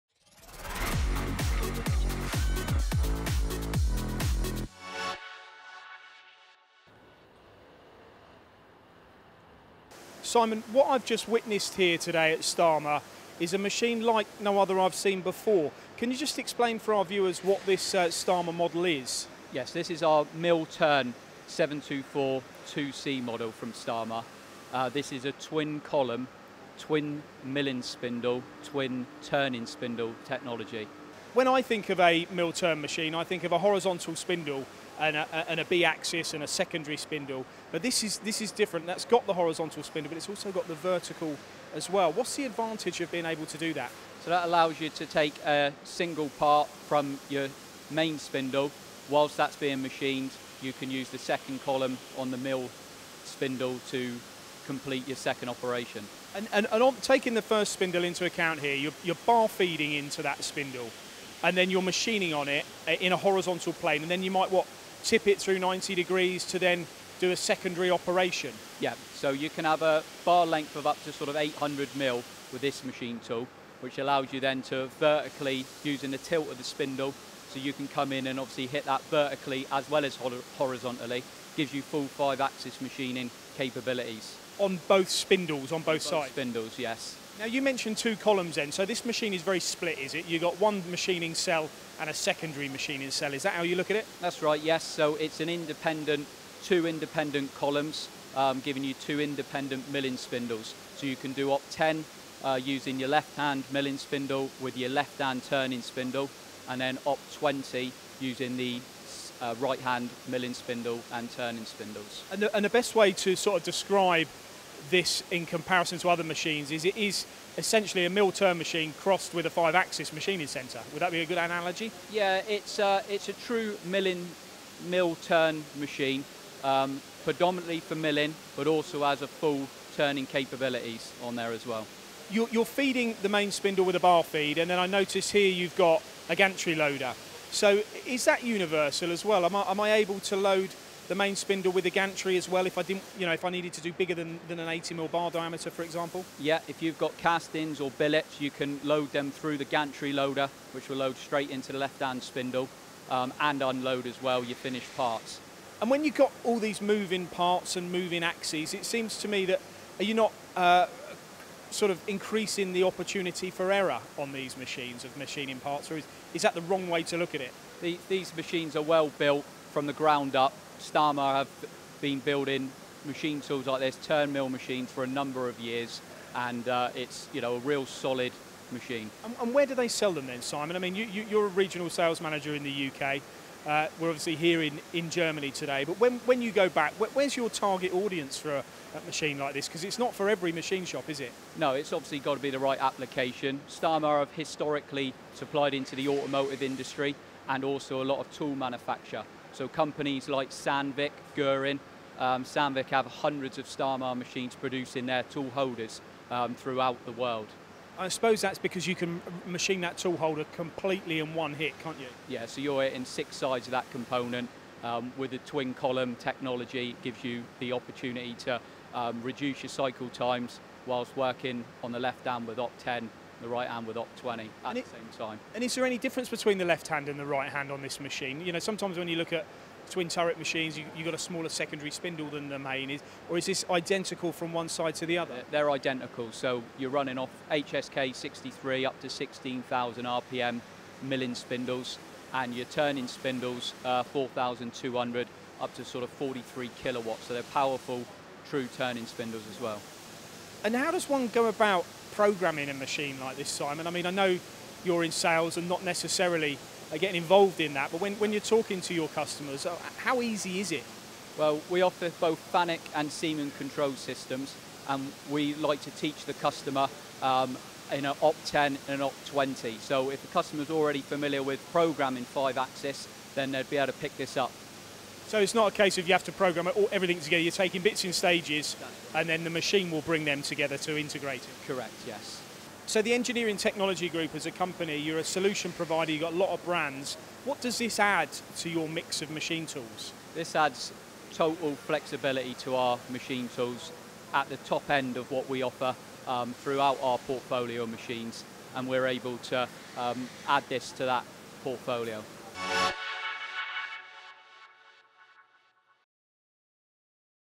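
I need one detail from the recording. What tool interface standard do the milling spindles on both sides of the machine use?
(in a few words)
HSK 63.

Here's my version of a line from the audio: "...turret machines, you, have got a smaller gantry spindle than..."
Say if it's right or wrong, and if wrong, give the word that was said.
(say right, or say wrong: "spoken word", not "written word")
wrong: "secondary", not "gantry".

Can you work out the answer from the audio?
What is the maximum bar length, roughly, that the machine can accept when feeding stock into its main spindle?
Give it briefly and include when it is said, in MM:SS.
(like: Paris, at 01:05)
800 mm, at 01:11.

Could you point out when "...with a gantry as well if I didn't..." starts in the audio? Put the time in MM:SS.
02:21.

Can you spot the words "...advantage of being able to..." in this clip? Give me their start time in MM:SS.
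00:42.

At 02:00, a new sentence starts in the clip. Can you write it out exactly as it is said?
Would that be a good analogy?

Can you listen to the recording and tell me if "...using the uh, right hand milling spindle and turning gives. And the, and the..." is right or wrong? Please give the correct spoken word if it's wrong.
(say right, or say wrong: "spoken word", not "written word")
wrong: "spindles", not "gives".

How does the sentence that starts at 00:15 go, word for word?
Can you just explain for our viewers what this uh, Stama model is?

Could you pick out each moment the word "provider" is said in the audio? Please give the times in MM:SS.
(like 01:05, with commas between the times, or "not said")
04:45.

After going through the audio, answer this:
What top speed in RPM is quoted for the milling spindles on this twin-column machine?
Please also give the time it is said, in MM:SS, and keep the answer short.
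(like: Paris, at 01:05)
16,000 RPM, at 03:59.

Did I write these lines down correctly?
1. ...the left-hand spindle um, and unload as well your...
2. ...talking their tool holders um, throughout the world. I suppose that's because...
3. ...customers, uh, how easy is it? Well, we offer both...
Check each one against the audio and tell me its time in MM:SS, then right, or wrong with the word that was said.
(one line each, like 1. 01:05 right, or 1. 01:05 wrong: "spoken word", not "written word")
1. 02:31 right
2. 03:24 wrong: "producing", not "talking"
3. 04:19 right.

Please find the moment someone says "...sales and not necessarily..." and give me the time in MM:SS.
04:15.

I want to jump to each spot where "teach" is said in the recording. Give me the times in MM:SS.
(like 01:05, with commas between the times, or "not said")
04:25.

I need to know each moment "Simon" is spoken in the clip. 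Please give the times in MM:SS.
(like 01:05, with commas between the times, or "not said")
00:10, 03:00, 04:13.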